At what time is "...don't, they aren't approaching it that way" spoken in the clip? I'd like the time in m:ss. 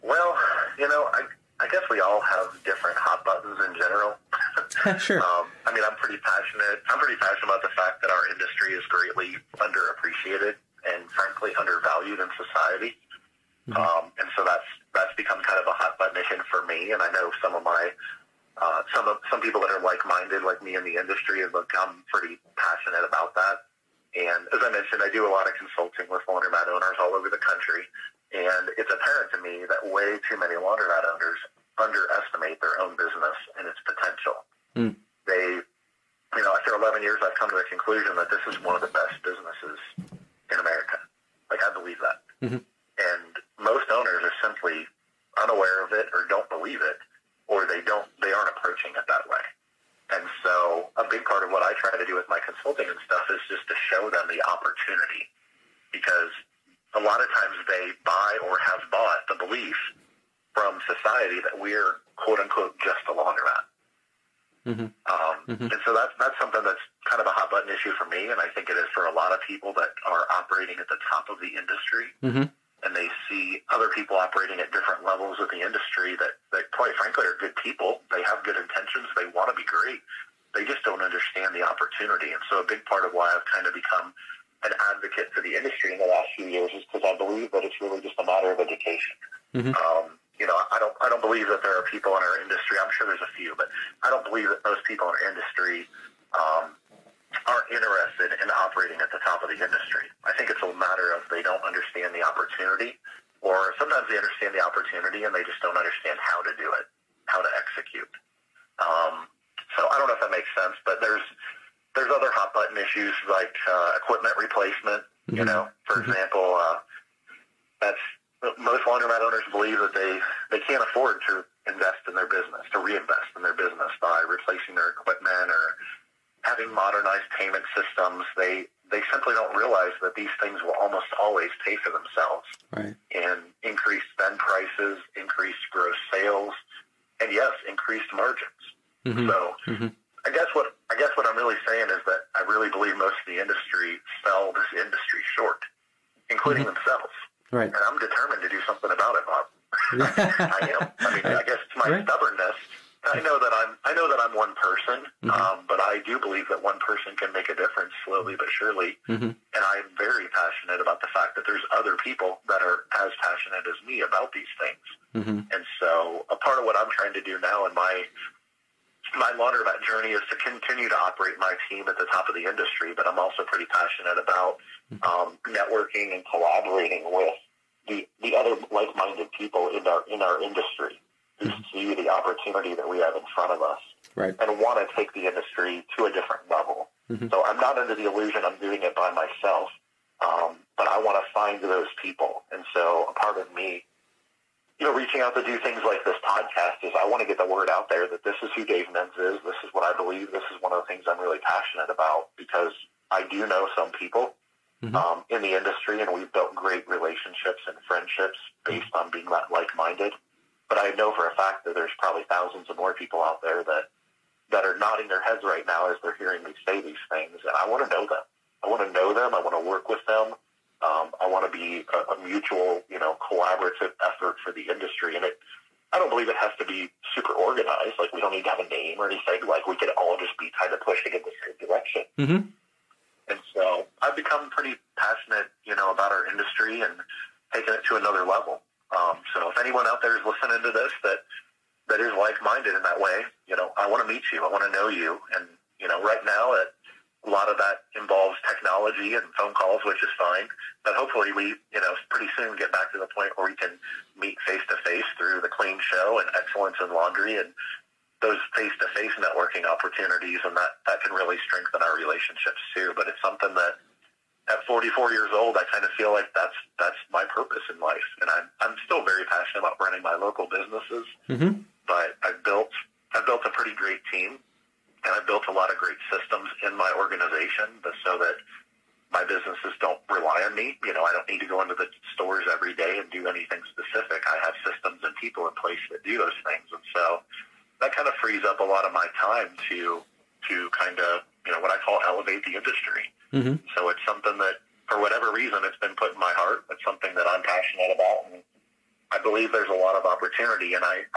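0:47.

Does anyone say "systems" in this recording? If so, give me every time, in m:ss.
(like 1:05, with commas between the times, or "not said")
4:36, 4:44.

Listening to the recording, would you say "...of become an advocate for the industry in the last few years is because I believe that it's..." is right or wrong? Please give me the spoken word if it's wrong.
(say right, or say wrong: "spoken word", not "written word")
right.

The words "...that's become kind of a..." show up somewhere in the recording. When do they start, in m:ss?
0:14.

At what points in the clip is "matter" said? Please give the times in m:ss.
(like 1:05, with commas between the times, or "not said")
1:28, 1:40.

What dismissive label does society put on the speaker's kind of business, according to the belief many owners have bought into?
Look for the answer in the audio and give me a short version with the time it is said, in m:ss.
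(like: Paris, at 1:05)
just a laundromat, at 1:02.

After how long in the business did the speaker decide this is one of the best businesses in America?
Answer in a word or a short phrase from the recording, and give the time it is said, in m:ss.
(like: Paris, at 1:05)
11 years, at 0:36.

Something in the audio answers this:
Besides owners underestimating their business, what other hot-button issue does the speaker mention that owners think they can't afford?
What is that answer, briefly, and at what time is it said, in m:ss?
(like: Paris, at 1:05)
equipment replacement, at 1:53.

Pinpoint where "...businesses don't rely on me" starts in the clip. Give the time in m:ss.
4:39.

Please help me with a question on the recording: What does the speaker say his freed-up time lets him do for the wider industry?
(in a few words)
elevate the industry.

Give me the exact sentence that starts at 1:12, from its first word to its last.
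Mm-hmm and they see other people operating at different levels of the industry that, that quite frankly are good people.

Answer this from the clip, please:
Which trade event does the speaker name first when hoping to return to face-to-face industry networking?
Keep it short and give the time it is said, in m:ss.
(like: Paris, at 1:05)
Clean Show, at 4:15.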